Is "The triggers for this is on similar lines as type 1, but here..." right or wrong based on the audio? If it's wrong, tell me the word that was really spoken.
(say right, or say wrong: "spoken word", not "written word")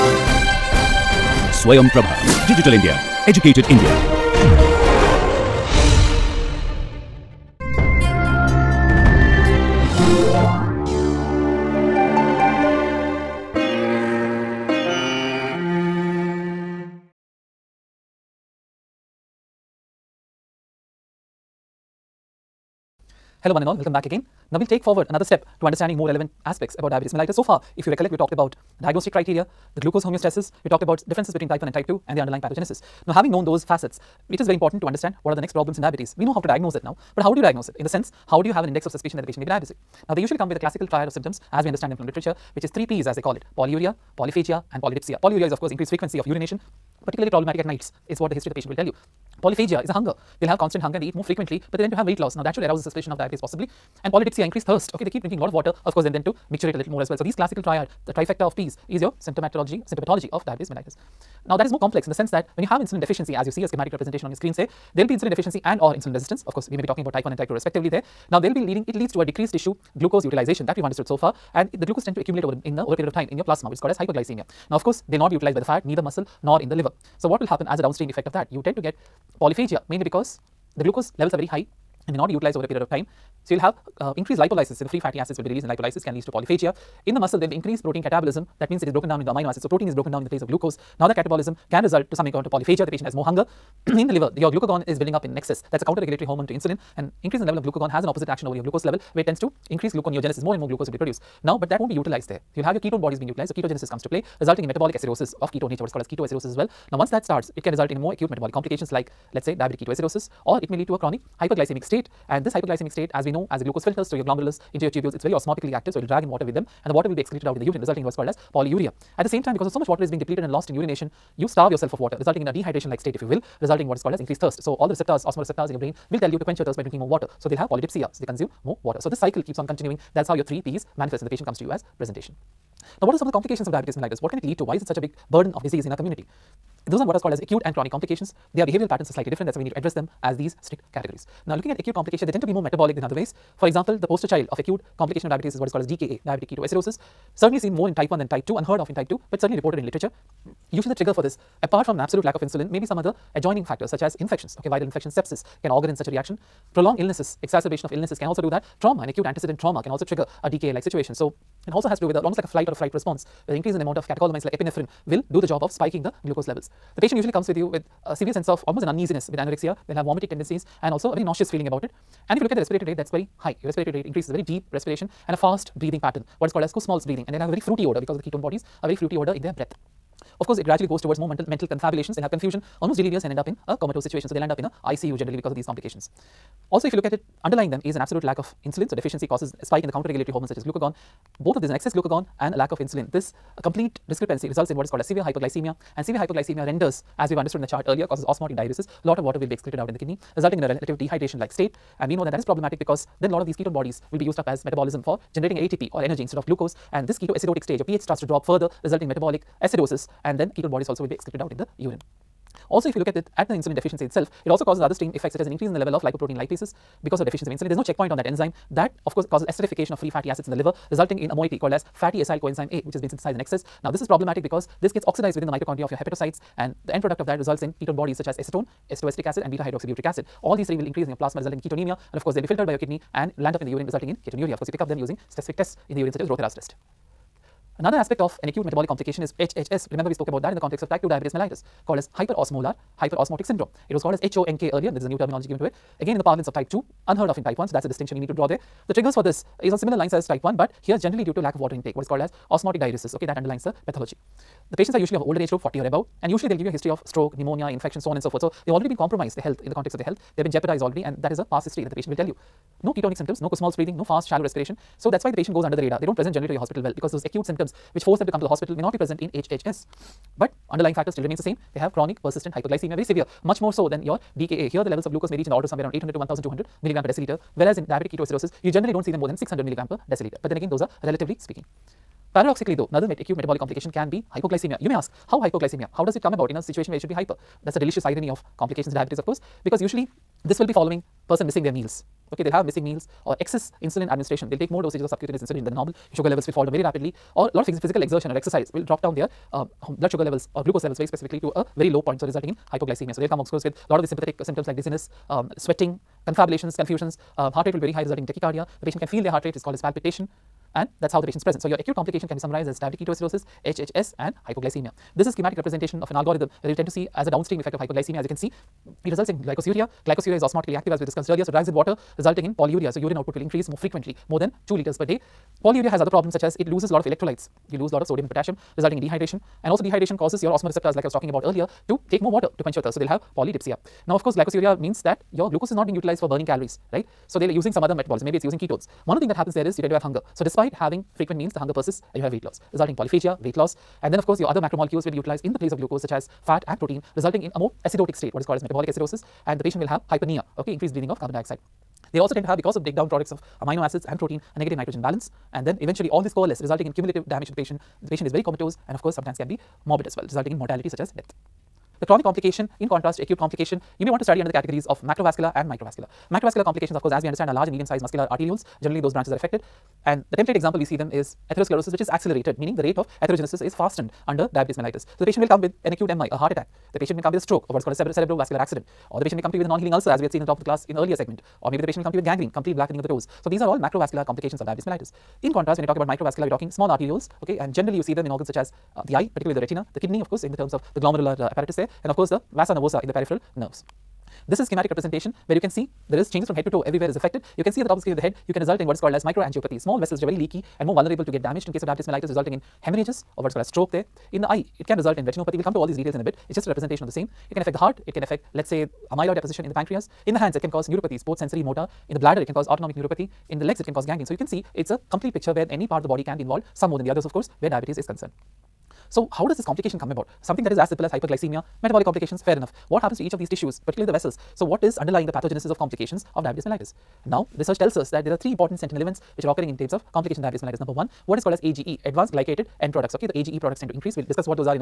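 right.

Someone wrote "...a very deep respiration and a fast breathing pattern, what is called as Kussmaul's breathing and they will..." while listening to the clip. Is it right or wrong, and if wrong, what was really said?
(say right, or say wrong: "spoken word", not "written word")
right.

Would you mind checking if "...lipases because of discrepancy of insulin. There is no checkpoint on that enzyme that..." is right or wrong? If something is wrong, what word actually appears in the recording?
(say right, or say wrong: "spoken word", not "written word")
wrong: "deficiency", not "discrepancy".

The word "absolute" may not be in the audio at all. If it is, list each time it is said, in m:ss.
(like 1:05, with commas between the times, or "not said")
2:31, 3:08.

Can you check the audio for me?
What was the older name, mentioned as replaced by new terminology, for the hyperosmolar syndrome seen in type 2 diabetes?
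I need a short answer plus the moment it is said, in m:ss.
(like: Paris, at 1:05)
HONK, at 4:04.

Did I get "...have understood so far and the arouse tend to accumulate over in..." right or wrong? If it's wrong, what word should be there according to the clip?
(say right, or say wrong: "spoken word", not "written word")
wrong: "glucose", not "arouse".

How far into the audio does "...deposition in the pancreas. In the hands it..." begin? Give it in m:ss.
6:49.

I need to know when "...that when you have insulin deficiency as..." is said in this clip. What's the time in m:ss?
1:02.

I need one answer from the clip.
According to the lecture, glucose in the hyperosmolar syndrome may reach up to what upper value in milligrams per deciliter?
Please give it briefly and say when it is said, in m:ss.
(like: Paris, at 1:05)
1200, at 4:36.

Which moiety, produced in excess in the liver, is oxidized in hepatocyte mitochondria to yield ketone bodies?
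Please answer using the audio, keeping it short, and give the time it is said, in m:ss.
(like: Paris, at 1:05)
fatty acyl coenzyme A, at 3:41.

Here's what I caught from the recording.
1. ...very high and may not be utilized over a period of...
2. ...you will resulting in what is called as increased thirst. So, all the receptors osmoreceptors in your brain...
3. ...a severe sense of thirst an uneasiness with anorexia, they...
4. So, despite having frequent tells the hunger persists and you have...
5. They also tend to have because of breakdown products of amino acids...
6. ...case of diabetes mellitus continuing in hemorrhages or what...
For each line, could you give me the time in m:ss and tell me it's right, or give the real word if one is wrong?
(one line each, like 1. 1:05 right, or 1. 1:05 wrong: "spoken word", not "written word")
1. 1:21 right
2. 2:03 right
3. 2:48 wrong: "almost", not "thirst"
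4. 5:40 wrong: "meals", not "tells"
5. 5:52 right
6. 6:41 wrong: "resulting", not "continuing".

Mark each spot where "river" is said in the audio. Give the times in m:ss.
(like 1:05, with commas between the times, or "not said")
not said.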